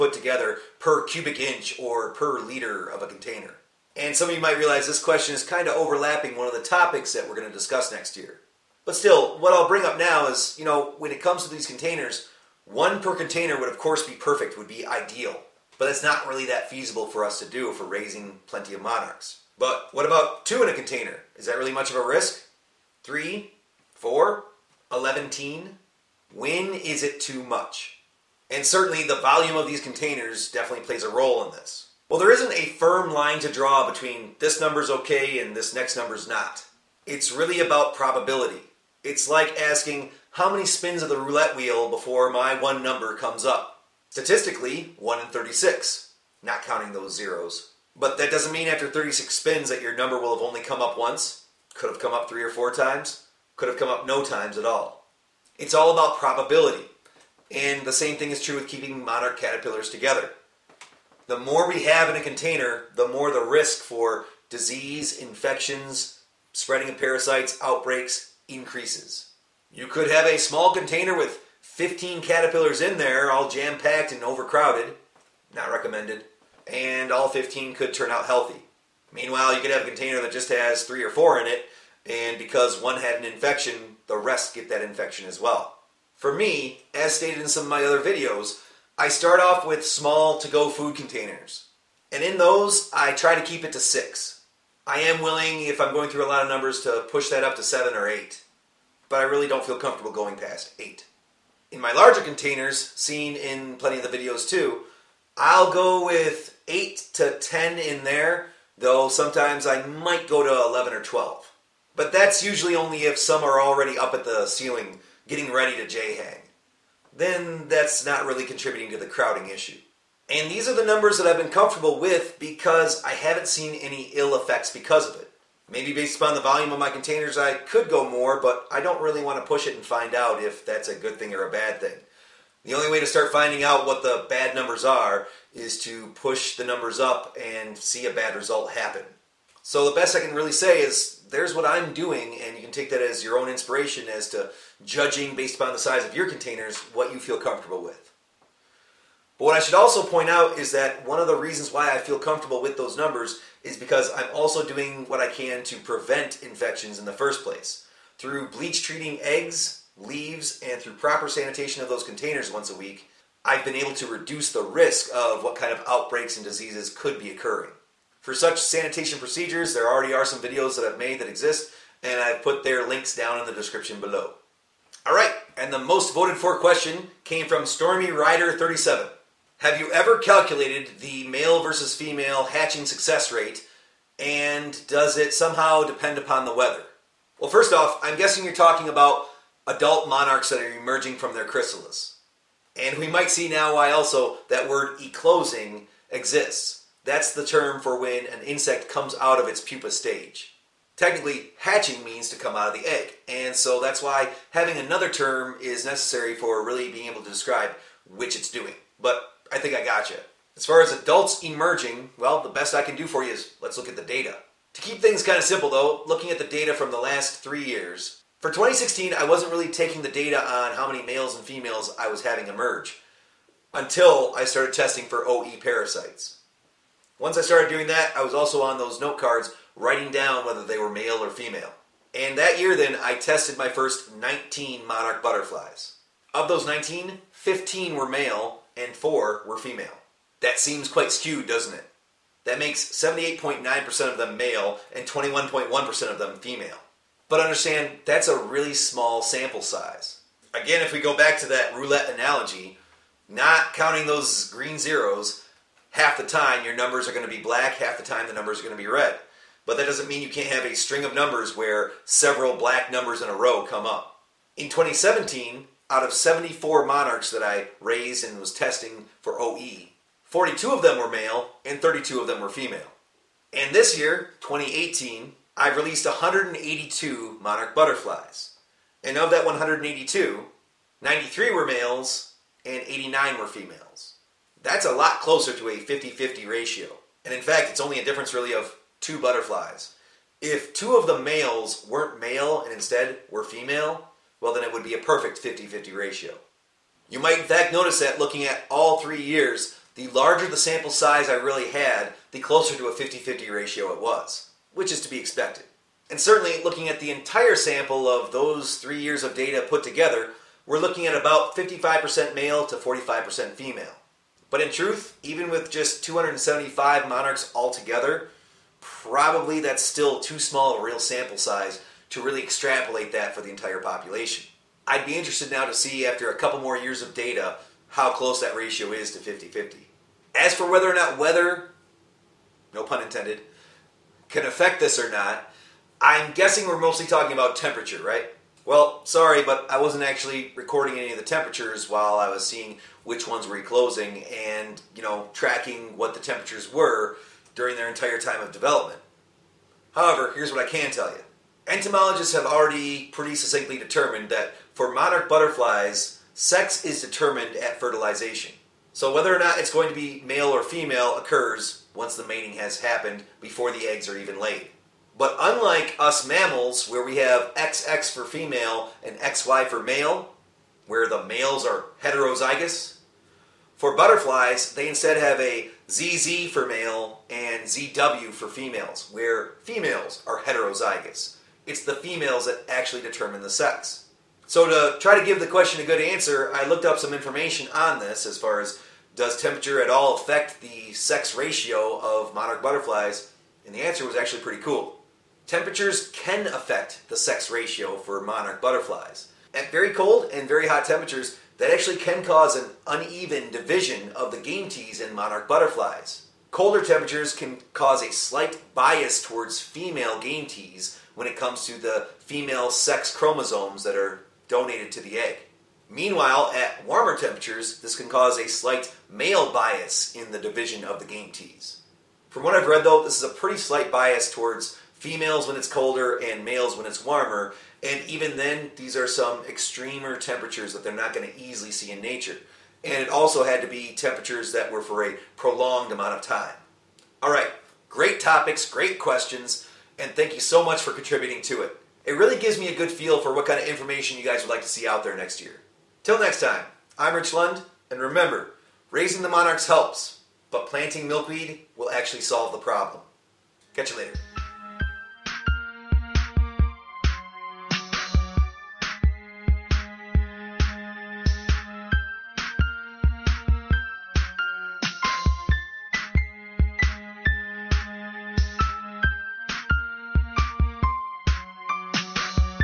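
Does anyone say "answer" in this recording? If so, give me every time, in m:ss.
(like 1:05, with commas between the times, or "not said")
6:26, 6:33.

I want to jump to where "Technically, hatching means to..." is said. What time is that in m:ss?
3:20.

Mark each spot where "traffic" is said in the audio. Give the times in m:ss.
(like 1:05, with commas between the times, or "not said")
not said.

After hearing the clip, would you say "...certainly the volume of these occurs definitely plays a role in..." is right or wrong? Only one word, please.
wrong.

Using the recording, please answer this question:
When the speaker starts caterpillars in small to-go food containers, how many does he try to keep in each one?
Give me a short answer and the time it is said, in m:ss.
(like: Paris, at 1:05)
6, at 1:33.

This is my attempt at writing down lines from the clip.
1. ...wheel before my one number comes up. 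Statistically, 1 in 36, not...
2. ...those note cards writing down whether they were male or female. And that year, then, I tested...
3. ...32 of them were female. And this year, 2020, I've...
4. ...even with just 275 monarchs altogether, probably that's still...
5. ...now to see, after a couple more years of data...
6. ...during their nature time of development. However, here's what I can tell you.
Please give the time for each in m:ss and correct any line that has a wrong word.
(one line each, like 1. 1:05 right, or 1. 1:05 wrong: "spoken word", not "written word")
1. 0:41 right
2. 3:48 right
3. 4:31 wrong: "2018", not "2020"
4. 5:15 right
5. 5:25 right
6. 5:47 wrong: "entire", not "nature".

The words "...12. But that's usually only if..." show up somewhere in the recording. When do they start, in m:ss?
1:51.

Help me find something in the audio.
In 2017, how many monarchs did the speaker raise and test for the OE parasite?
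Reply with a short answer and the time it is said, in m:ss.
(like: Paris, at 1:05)
74, at 4:26.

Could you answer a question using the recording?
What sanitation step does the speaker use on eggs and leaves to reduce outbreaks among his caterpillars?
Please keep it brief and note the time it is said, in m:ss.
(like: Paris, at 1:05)
bleach treating, at 2:38.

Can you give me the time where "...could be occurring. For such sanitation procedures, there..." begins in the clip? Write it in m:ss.
2:46.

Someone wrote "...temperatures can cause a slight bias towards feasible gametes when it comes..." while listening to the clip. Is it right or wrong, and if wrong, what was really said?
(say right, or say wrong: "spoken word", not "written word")
wrong: "female", not "feasible".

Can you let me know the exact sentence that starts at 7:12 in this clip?
And it also had to be temperatures that were for a prolonged amount of time.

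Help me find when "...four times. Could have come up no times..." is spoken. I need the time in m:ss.
0:52.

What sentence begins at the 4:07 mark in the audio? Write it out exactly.
But understand that's a really small sample size.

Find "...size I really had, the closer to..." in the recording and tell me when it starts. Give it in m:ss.
5:00.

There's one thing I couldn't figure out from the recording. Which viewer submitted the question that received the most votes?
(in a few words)
Stormy Rider 37.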